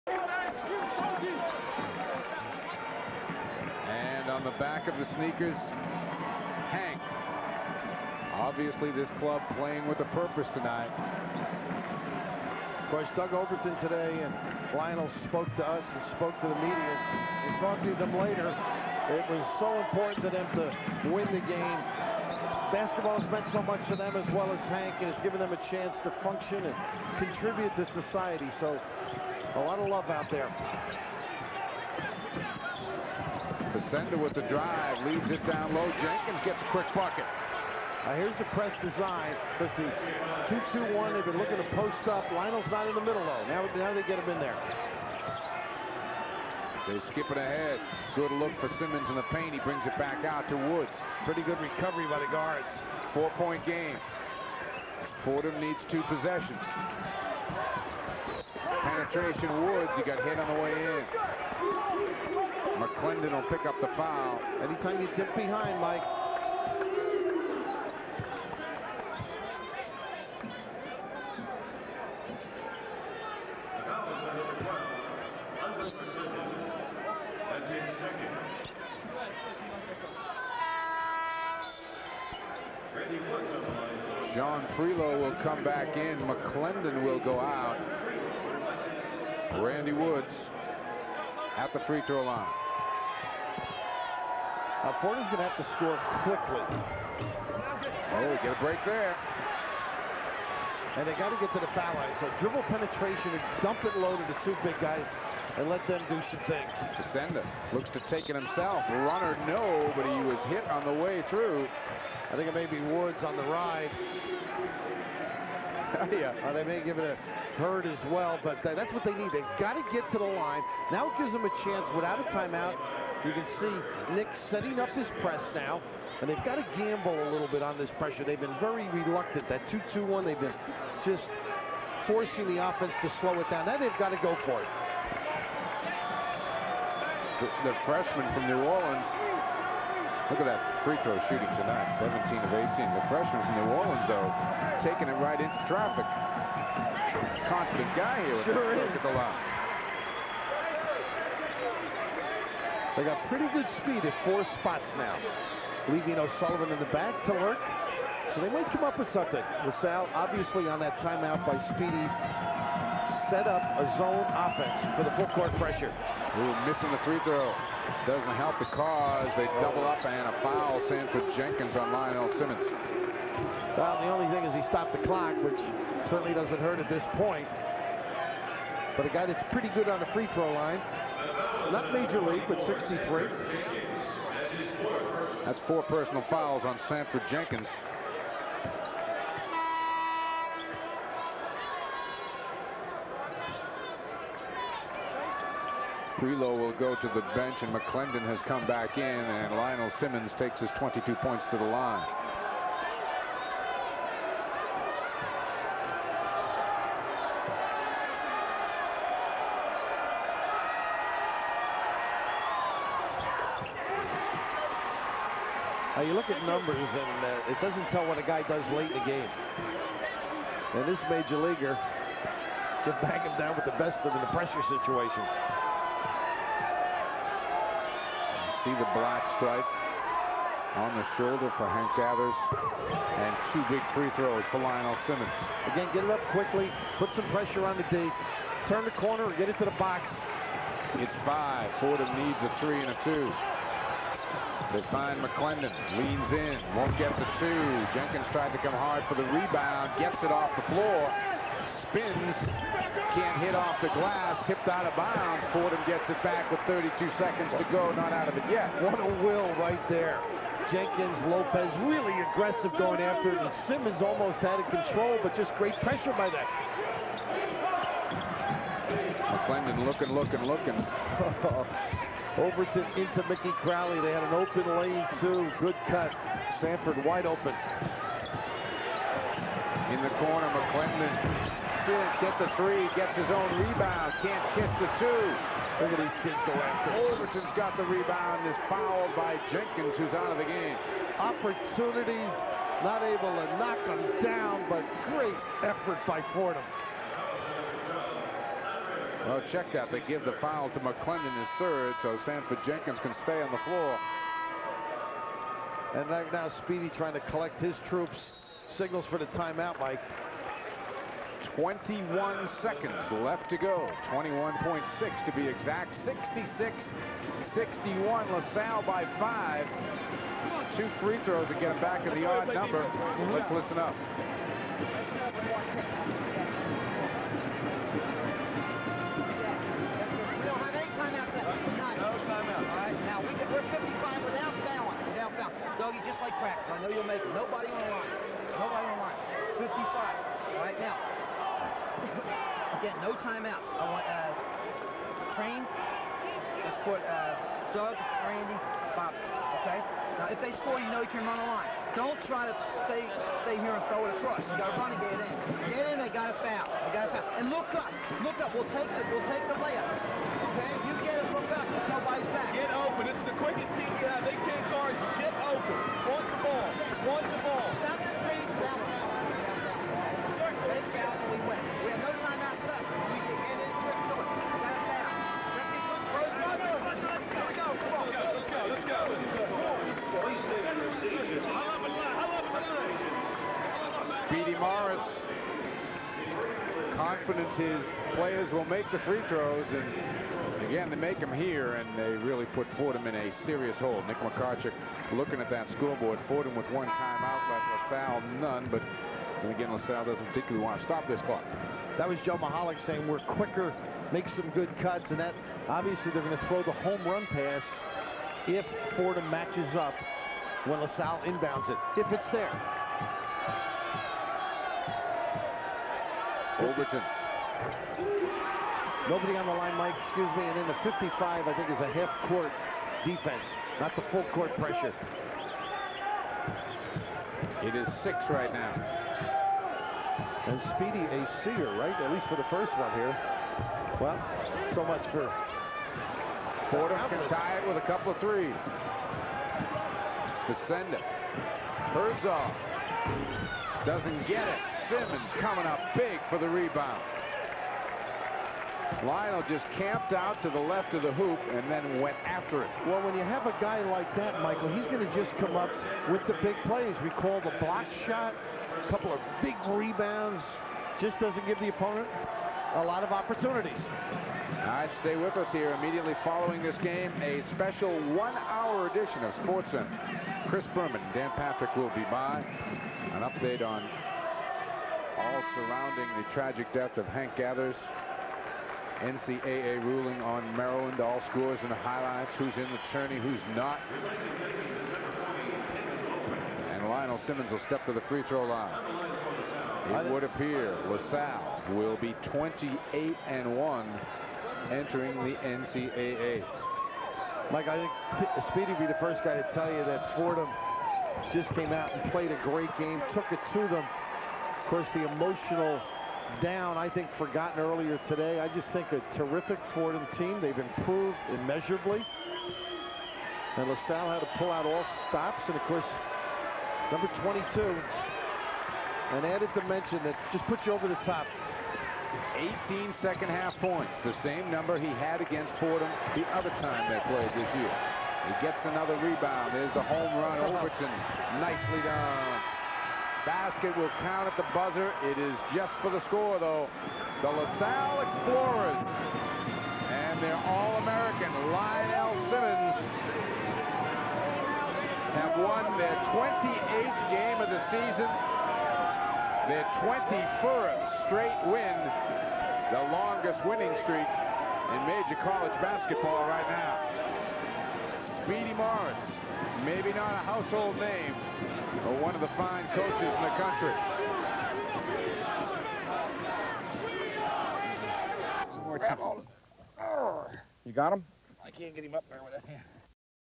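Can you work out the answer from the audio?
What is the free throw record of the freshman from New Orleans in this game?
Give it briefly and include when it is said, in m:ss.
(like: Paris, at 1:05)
17 of 18, at 2:21.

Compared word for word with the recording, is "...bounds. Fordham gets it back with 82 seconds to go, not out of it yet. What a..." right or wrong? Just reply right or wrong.
wrong.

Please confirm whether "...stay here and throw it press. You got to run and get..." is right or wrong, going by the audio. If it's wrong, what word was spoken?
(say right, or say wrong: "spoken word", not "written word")
wrong: "across", not "press".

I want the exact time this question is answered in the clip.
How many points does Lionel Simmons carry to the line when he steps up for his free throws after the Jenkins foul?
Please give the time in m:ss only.
3:20.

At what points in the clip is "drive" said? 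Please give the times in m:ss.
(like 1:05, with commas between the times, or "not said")
0:34.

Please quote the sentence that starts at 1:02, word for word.
McClendon will pick up the foul.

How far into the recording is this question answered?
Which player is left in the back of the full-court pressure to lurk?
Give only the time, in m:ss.
2:36.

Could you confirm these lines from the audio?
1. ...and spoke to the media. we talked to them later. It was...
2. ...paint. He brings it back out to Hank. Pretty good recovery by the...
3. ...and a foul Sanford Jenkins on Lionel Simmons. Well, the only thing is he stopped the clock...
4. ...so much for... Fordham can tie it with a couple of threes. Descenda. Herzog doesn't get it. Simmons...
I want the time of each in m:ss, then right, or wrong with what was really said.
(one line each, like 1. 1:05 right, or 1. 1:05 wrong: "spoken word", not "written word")
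1. 0:15 right
2. 0:49 wrong: "Woods", not "Hank"
3. 2:50 right
4. 7:14 right.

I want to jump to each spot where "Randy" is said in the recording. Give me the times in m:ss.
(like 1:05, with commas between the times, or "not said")
1:29, 5:48.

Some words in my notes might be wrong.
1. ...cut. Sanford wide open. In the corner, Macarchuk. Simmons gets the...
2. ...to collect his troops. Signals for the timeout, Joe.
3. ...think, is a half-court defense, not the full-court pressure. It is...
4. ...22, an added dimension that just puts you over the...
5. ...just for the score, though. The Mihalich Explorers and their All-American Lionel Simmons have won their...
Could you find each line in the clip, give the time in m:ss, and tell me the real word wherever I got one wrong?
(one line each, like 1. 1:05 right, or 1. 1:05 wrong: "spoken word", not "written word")
1. 4:35 wrong: "McClendon", not "Macarchuk"
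2. 5:07 wrong: "Mike", not "Joe"
3. 7:01 right
4. 8:37 right
5. 8:55 wrong: "LaSalle", not "Mihalich".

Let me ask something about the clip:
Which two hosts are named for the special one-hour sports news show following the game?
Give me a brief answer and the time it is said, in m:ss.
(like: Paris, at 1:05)
Chris Berman, Dan Patrick, at 7:50.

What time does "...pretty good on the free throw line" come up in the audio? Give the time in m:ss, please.
2:59.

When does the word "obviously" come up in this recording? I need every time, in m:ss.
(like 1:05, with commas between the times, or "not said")
0:08, 2:40, 6:45.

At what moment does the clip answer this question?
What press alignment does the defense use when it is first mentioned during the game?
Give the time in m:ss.
0:39.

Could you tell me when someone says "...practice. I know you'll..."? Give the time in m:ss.
5:36.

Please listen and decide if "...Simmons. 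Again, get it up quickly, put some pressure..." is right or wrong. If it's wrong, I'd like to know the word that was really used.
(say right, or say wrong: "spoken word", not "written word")
right.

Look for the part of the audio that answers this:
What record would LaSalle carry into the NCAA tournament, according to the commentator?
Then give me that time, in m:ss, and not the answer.
8:12.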